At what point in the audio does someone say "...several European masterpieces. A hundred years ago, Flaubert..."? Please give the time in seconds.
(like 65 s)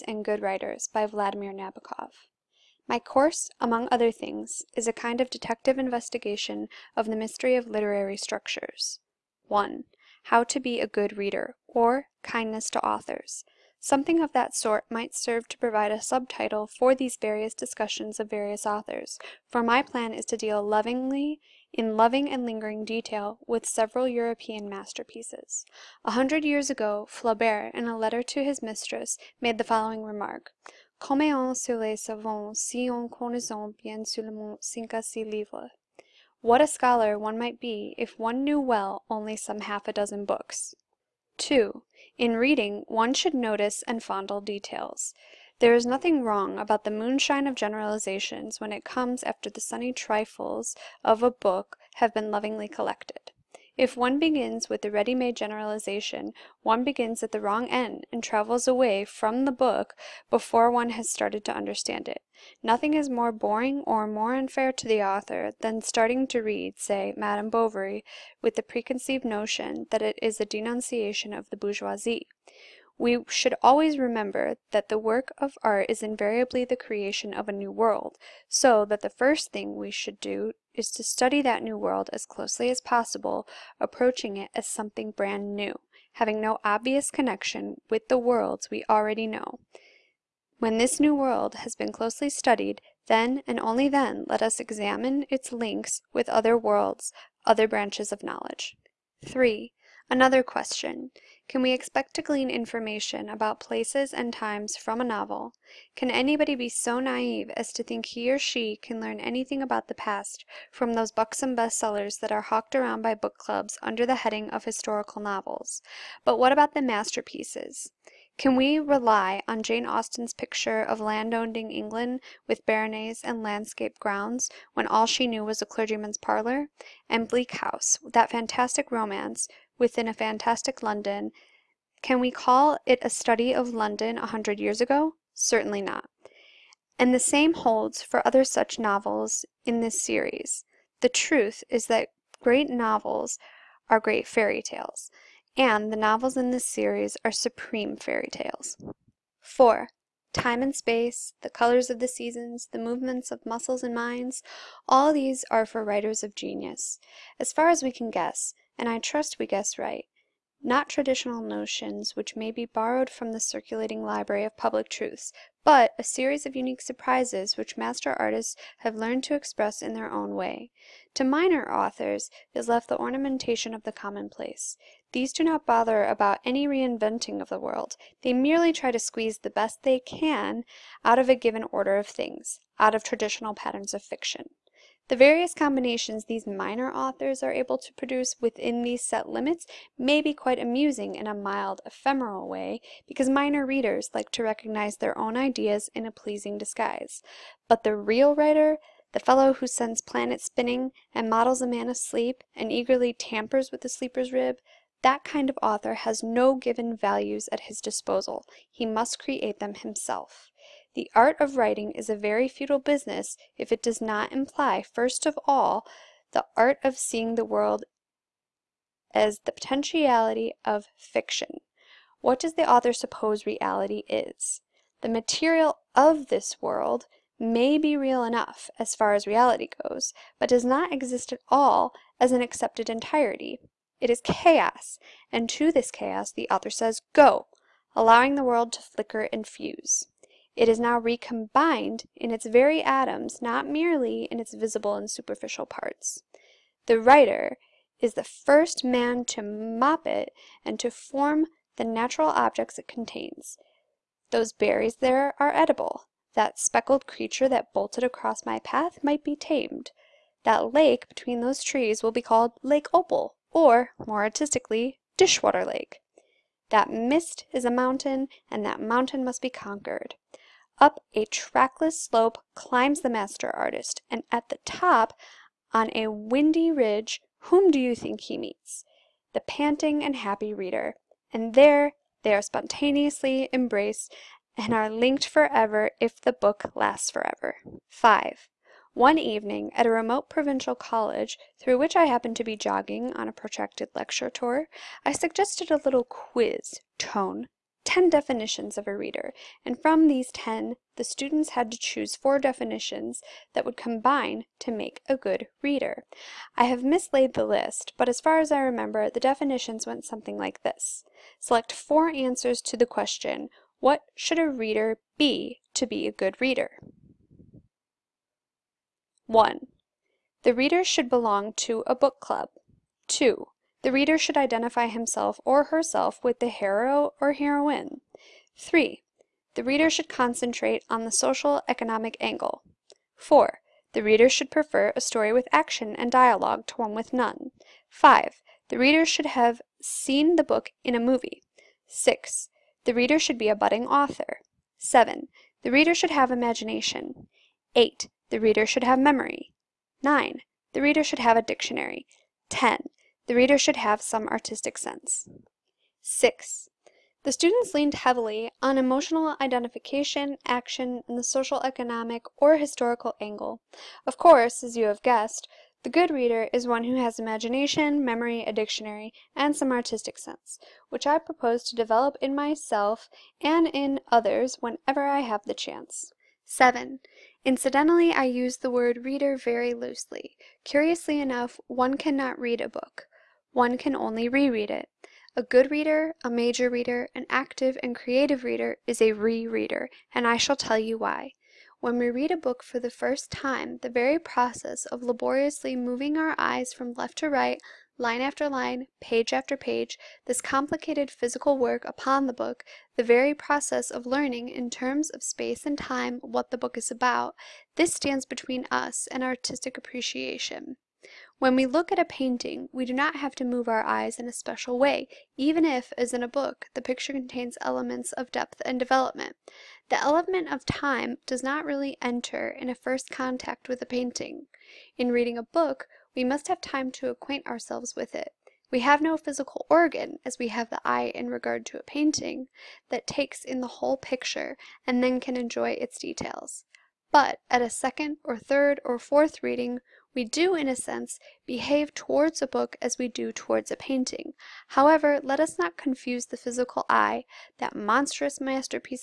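23 s.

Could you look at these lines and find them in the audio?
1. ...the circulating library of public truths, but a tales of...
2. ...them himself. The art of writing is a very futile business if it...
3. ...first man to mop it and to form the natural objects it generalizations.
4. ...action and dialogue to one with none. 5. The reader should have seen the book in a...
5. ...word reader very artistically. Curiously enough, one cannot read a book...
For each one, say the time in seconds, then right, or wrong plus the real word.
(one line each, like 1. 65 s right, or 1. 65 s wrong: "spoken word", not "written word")
1. 163 s wrong: "series", not "tales"
2. 209 s right
3. 248 s wrong: "contains", not "generalizations"
4. 335 s right
5. 378 s wrong: "loosely", not "artistically".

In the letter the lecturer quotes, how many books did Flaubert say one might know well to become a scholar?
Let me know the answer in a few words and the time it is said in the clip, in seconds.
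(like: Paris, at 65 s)
half a dozen, at 39 s.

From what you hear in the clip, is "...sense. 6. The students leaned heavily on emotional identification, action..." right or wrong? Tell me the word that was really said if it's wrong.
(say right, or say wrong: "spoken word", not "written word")
right.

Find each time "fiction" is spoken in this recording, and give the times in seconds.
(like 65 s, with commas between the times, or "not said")
184 s, 220 s.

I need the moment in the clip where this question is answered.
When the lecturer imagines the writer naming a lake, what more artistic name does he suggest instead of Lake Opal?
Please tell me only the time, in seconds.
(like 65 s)
265 s.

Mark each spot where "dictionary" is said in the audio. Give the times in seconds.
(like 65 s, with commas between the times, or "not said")
351 s, 368 s.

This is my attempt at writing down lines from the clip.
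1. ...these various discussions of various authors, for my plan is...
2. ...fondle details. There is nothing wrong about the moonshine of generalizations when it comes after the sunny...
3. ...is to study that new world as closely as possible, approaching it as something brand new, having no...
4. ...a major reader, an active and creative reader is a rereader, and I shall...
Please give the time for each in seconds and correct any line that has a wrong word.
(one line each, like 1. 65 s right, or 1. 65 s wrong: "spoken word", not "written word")
1. 16 s right
2. 44 s right
3. 80 s right
4. 386 s right.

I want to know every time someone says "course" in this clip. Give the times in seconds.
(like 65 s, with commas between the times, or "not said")
2 s, 364 s.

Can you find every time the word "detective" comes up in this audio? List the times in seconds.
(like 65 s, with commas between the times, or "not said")
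5 s.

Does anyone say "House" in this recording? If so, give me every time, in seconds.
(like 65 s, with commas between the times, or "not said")
127 s.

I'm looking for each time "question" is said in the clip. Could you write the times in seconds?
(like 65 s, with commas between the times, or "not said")
100 s, 312 s.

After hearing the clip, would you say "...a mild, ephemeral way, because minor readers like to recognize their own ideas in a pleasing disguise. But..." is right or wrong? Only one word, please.
right.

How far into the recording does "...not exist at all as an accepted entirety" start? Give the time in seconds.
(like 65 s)
230 s.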